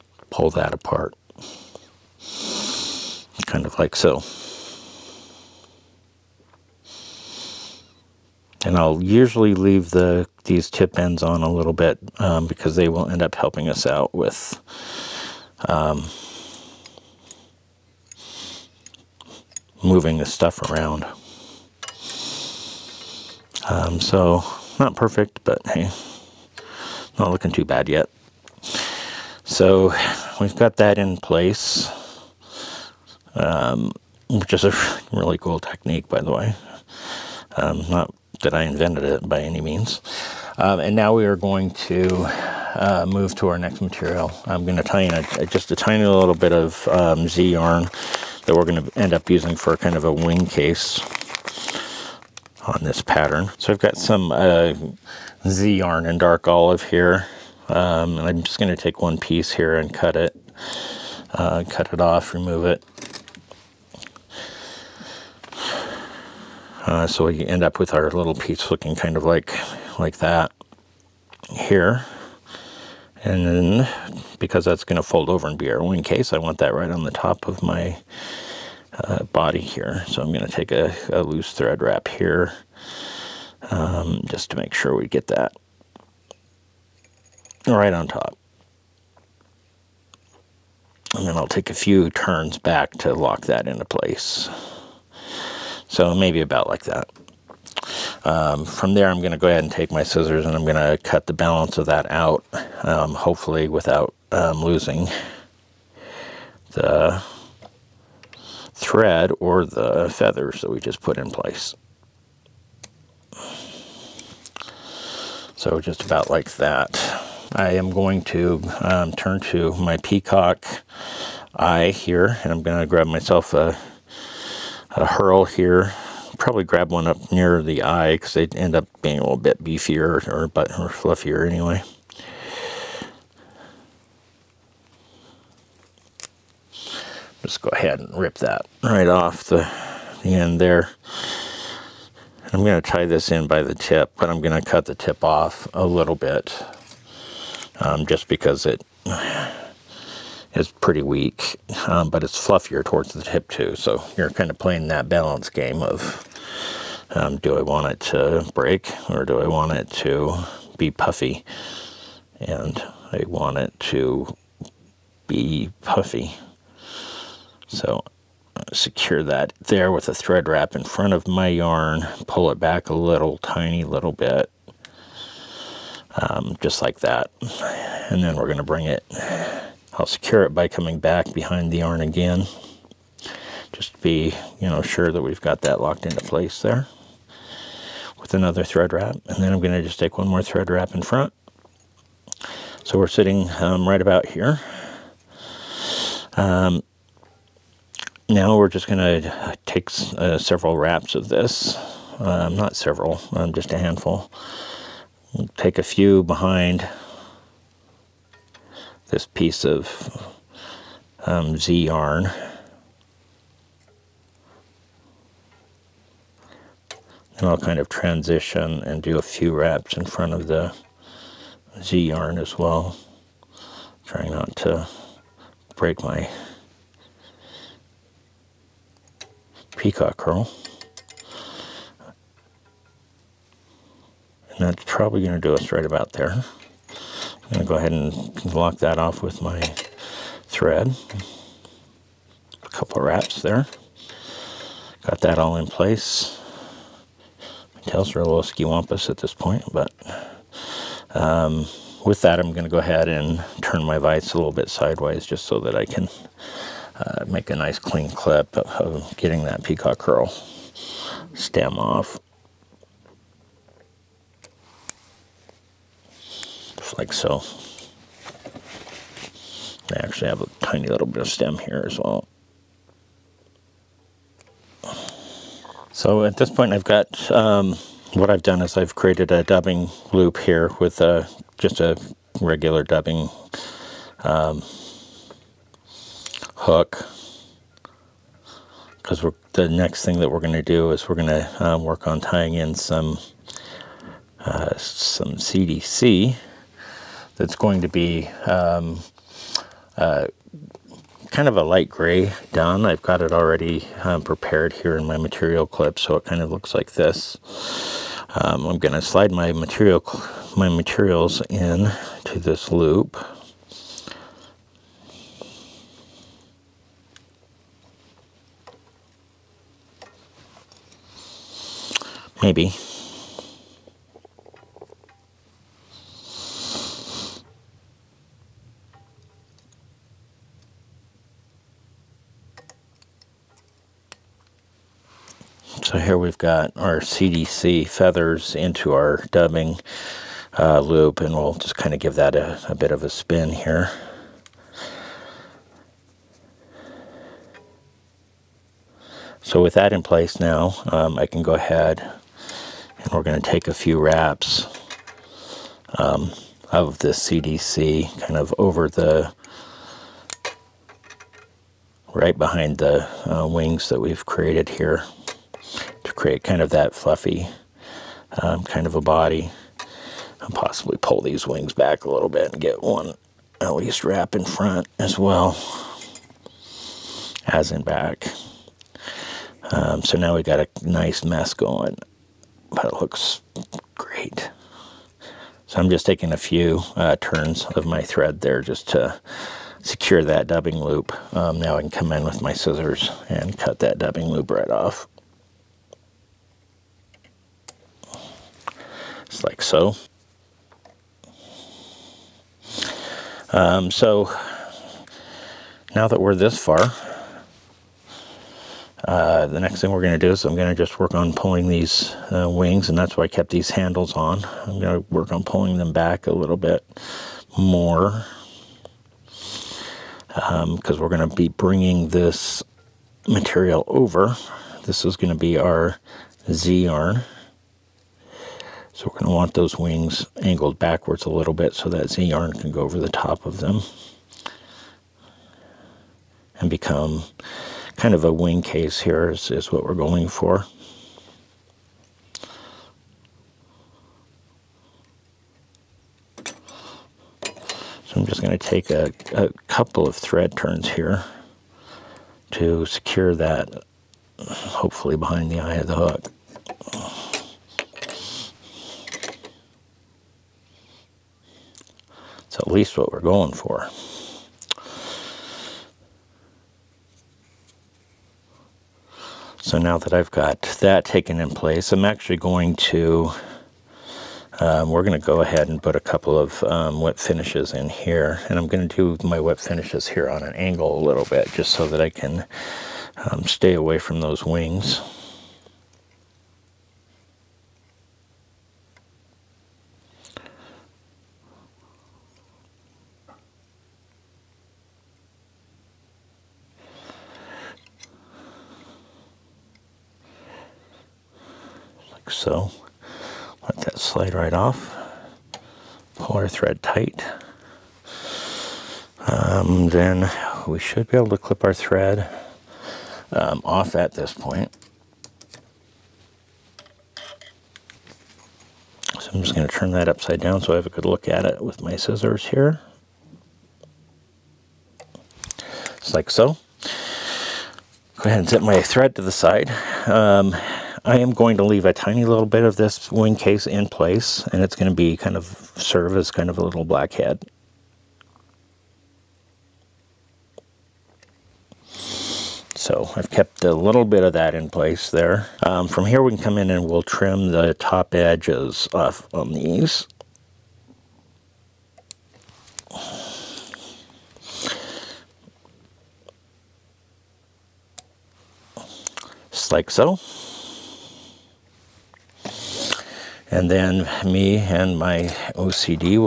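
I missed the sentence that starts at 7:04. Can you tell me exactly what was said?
This is going to be our Z-yarn.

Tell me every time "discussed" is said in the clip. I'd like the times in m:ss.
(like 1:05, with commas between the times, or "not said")
not said.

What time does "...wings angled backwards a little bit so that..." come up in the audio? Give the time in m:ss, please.
7:09.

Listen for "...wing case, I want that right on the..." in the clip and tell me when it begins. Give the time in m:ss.
1:15.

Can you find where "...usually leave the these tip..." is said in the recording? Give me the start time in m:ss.
0:09.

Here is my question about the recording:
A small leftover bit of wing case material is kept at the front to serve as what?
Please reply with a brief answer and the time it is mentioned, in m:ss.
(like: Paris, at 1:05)
little black head, at 8:56.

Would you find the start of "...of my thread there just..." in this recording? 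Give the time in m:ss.
6:27.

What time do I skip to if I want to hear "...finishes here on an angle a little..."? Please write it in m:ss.
7:59.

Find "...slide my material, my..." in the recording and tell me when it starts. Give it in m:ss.
5:09.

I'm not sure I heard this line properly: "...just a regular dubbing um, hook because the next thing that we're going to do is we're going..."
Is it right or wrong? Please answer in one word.
right.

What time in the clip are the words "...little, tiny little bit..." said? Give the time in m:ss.
2:52.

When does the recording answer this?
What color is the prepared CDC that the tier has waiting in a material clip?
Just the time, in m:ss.
5:01.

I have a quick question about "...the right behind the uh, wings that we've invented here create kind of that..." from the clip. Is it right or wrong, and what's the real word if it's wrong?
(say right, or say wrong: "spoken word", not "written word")
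wrong: "created", not "invented".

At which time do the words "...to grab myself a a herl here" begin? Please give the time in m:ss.
2:02.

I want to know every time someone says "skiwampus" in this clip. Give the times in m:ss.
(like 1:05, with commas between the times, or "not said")
4:08.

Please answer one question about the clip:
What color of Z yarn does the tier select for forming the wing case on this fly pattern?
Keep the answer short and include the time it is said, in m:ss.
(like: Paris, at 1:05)
dark olive, at 0:56.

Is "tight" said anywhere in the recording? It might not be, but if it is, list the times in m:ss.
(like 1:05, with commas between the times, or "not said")
8:26.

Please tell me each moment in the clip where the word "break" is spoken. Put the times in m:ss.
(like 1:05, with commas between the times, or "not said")
2:38, 3:45.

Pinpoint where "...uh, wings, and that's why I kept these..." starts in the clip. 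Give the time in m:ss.
6:52.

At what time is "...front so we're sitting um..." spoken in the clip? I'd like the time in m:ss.
3:11.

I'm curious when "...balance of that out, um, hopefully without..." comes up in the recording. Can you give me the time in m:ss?
1:41.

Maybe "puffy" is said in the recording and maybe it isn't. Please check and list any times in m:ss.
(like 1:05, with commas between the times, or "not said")
2:40, 2:45.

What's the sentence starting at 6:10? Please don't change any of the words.
And possibly pull these wings back a little bit and get one at least wrap in front as well as in back.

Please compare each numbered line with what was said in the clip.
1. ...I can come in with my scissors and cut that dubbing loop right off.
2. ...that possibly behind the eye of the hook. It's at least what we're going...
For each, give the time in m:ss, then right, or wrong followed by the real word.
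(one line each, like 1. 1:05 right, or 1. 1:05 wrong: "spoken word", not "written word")
1. 6:31 right
2. 7:33 wrong: "hopefully", not "possibly".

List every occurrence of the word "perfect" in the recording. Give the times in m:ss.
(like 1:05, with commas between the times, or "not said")
0:24.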